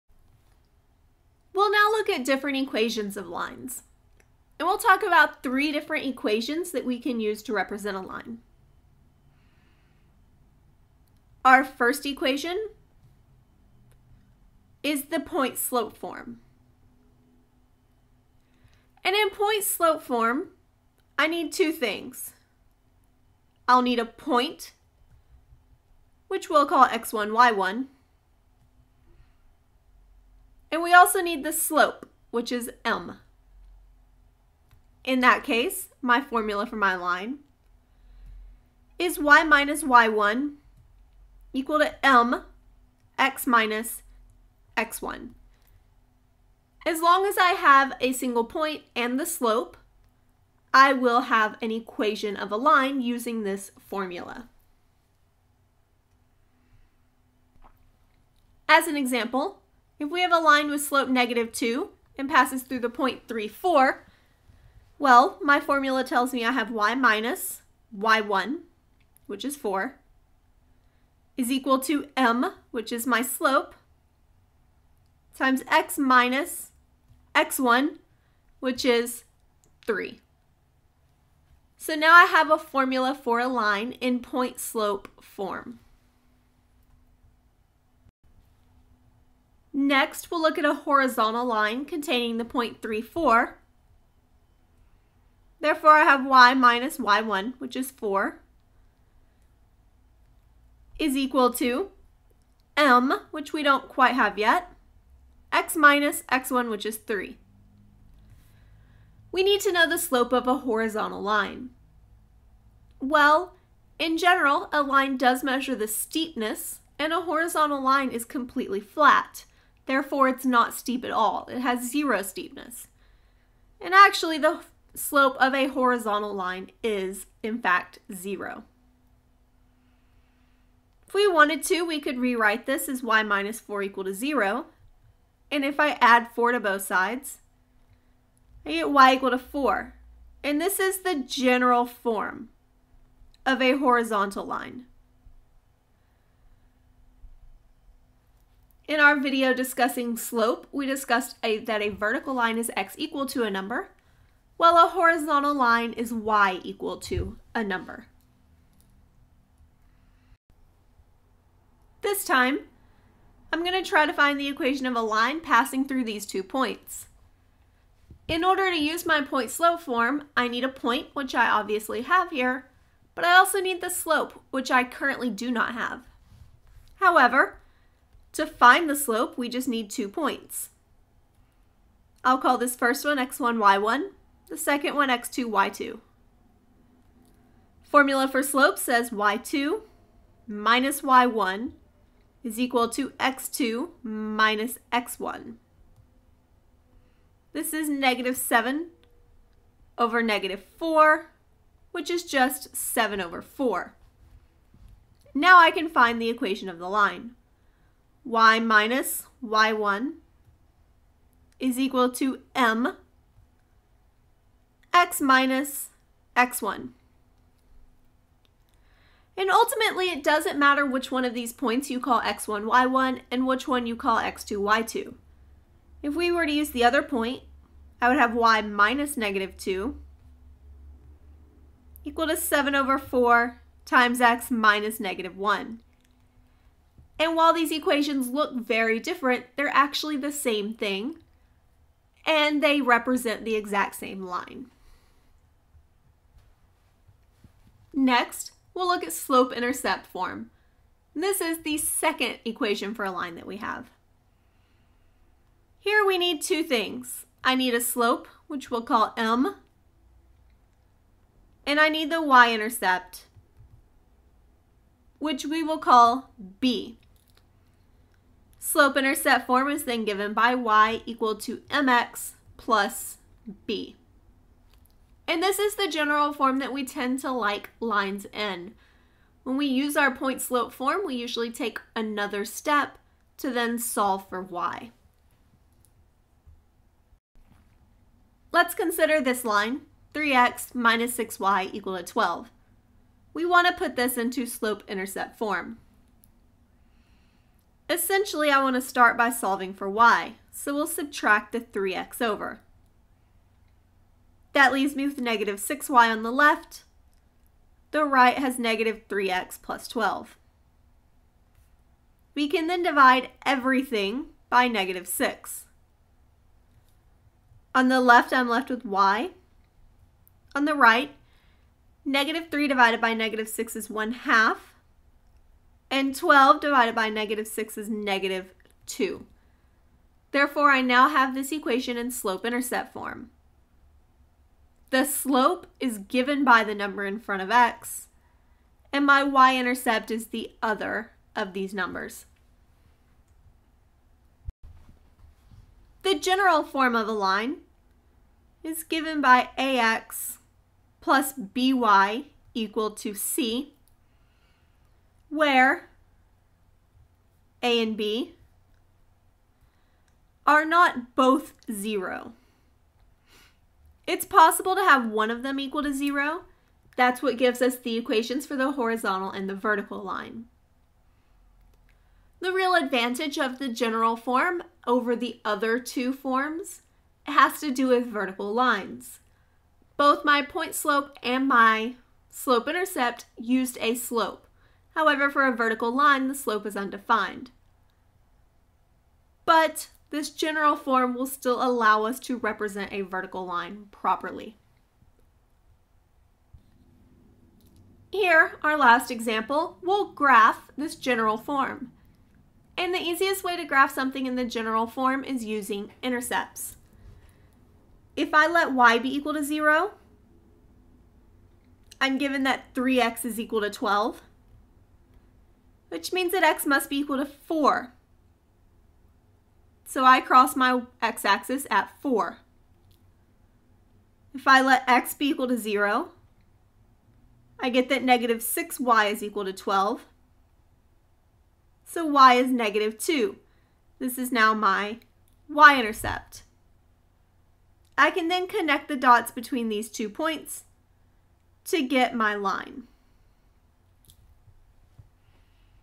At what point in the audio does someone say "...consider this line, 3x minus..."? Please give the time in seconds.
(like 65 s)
288 s.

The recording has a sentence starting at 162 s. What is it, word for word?
This time, I'm going to try to find the equation of a line passing through these two points.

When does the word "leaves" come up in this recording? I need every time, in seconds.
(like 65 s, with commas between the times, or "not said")
304 s.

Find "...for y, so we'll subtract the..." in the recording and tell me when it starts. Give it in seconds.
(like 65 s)
299 s.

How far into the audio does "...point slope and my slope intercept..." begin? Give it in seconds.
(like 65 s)
380 s.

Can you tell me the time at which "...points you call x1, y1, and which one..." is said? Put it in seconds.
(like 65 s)
221 s.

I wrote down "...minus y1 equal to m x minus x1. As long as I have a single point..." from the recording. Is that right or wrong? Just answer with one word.
right.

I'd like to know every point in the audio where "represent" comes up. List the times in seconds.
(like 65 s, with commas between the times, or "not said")
7 s, 242 s, 392 s.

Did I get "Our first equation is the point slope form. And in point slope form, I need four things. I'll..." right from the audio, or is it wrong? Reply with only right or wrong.
wrong.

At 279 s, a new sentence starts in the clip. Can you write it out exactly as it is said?
When we use our point slope form, we usually take another step to then solve for y.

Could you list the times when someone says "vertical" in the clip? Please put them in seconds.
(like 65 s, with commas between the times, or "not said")
151 s, 369 s, 378 s, 385 s, 393 s.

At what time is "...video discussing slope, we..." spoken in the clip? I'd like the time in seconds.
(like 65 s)
149 s.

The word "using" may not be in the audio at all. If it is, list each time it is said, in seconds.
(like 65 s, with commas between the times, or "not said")
53 s, 405 s.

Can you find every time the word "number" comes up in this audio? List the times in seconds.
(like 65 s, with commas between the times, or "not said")
153 s, 157 s, 336 s, 341 s.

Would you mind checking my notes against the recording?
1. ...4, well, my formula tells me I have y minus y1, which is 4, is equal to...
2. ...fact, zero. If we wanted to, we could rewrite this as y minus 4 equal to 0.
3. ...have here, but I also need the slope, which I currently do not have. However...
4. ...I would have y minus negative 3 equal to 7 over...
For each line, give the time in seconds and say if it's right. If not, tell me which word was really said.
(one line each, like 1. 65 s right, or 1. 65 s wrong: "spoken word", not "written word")
1. 63 s right
2. 127 s right
3. 172 s right
4. 228 s wrong: "2", not "3".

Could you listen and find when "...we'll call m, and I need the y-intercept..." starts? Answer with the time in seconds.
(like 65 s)
258 s.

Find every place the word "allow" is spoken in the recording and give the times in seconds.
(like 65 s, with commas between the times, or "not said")
391 s.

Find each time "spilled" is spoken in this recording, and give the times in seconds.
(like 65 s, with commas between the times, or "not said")
not said.